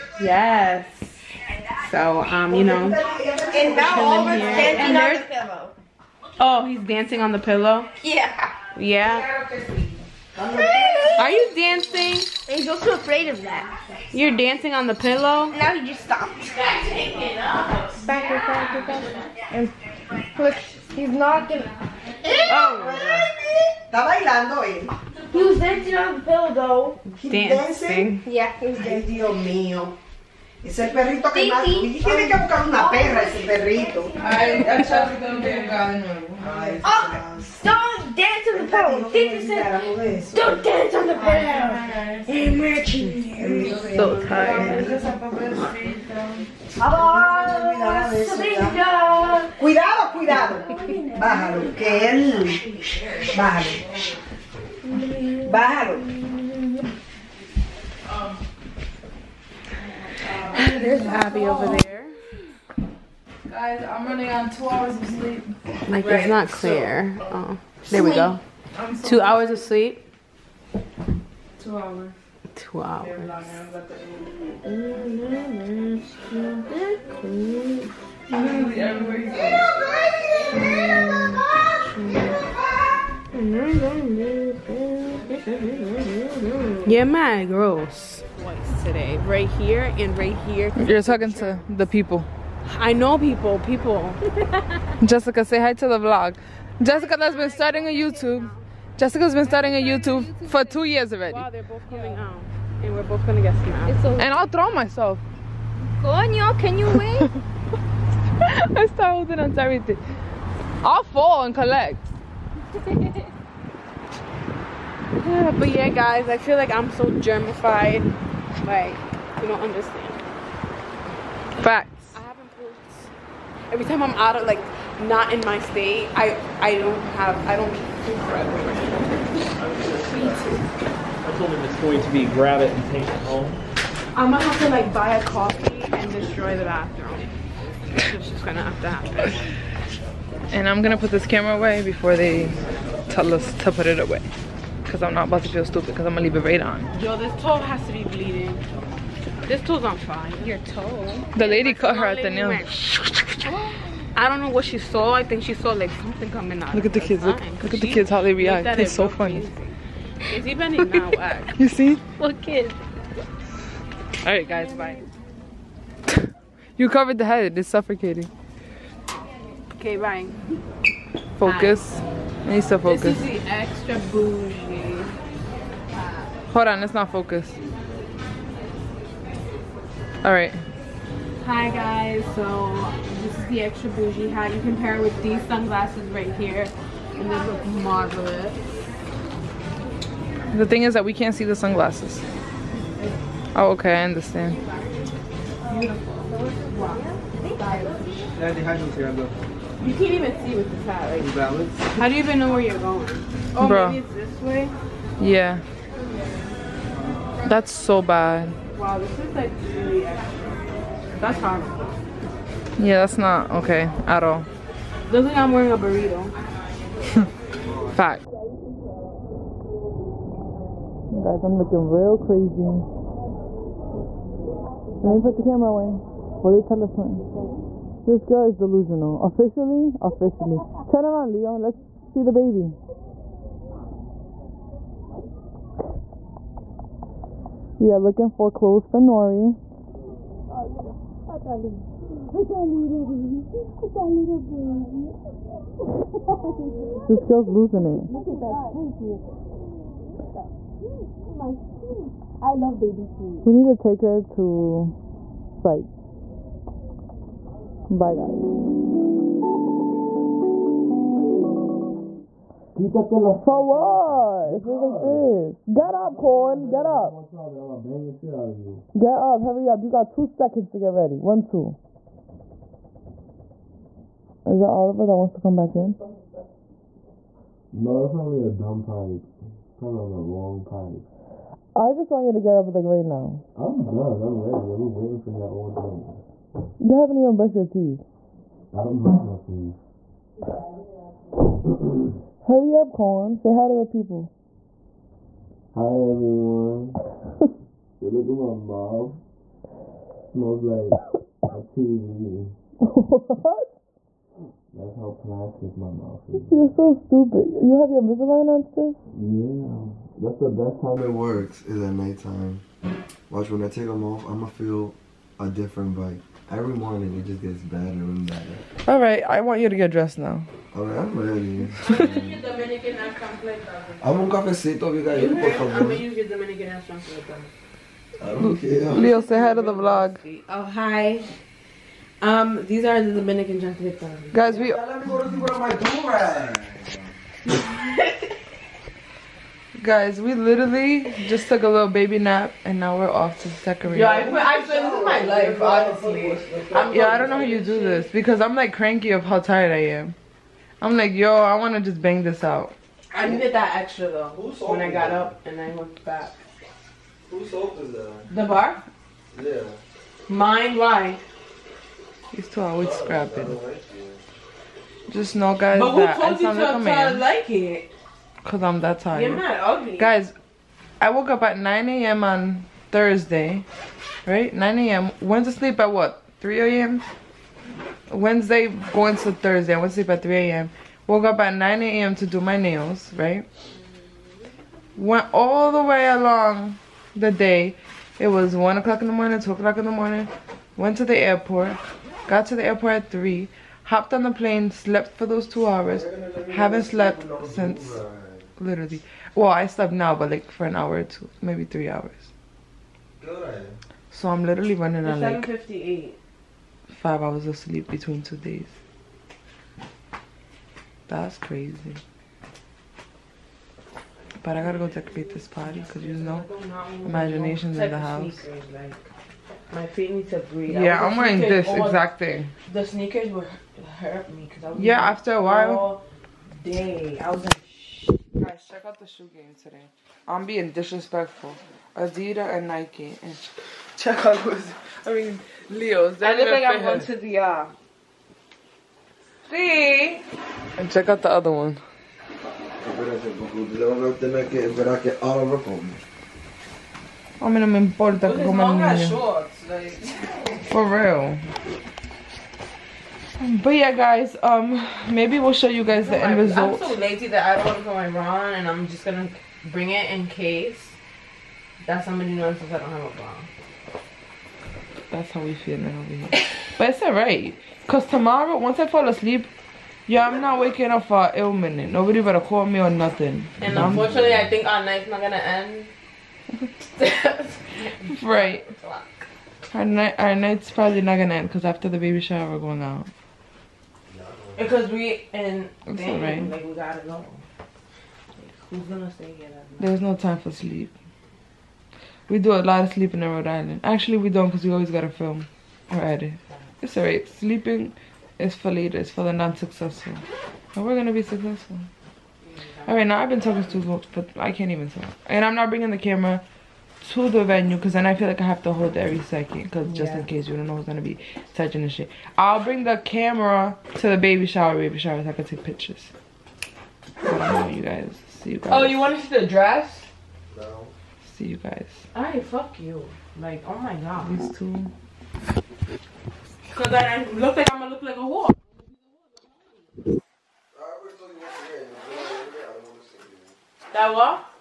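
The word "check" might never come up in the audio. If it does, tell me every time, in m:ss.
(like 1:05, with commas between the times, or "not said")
7:08, 7:13, 7:20.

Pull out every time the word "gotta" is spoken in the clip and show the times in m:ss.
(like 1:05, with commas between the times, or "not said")
6:54, 8:06, 8:14.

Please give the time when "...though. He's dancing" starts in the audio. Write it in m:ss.
0:26.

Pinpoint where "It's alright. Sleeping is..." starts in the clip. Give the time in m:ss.
8:16.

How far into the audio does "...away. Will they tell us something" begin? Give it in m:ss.
3:45.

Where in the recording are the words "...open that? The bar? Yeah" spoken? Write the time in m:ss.
5:57.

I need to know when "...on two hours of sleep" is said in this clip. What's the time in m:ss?
1:04.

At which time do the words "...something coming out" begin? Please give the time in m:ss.
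2:36.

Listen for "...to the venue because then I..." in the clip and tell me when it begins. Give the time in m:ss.
8:27.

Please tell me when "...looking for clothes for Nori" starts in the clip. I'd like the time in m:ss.
3:57.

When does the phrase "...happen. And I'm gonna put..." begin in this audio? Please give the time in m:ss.
2:18.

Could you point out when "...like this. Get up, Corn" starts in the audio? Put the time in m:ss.
4:24.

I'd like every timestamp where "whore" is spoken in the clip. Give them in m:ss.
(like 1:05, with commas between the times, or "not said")
8:48.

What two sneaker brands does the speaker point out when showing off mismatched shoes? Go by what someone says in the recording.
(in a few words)
Adidas and Nike.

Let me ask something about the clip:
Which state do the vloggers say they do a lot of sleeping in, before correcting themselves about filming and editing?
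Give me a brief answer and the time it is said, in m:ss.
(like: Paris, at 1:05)
Rhode Island, at 8:13.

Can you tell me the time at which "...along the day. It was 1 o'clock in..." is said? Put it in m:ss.
6:26.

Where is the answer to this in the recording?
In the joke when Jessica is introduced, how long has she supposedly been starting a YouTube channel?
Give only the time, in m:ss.
1:40.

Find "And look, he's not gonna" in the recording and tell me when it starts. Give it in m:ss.
0:19.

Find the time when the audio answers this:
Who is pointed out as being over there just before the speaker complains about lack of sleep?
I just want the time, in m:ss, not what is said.
1:01.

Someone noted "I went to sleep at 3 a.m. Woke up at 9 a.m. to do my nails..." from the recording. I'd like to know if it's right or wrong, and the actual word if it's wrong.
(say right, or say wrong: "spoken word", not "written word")
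right.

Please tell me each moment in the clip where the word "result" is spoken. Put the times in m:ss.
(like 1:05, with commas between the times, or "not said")
7:36.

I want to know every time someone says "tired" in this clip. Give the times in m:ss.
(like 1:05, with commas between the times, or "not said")
0:44, 5:49, 6:08.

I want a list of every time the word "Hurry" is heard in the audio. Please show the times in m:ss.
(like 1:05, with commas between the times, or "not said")
4:29, 4:52.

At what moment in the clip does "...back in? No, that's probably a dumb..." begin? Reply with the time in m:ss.
4:35.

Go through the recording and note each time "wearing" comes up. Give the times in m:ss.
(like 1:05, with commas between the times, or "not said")
3:35, 7:01.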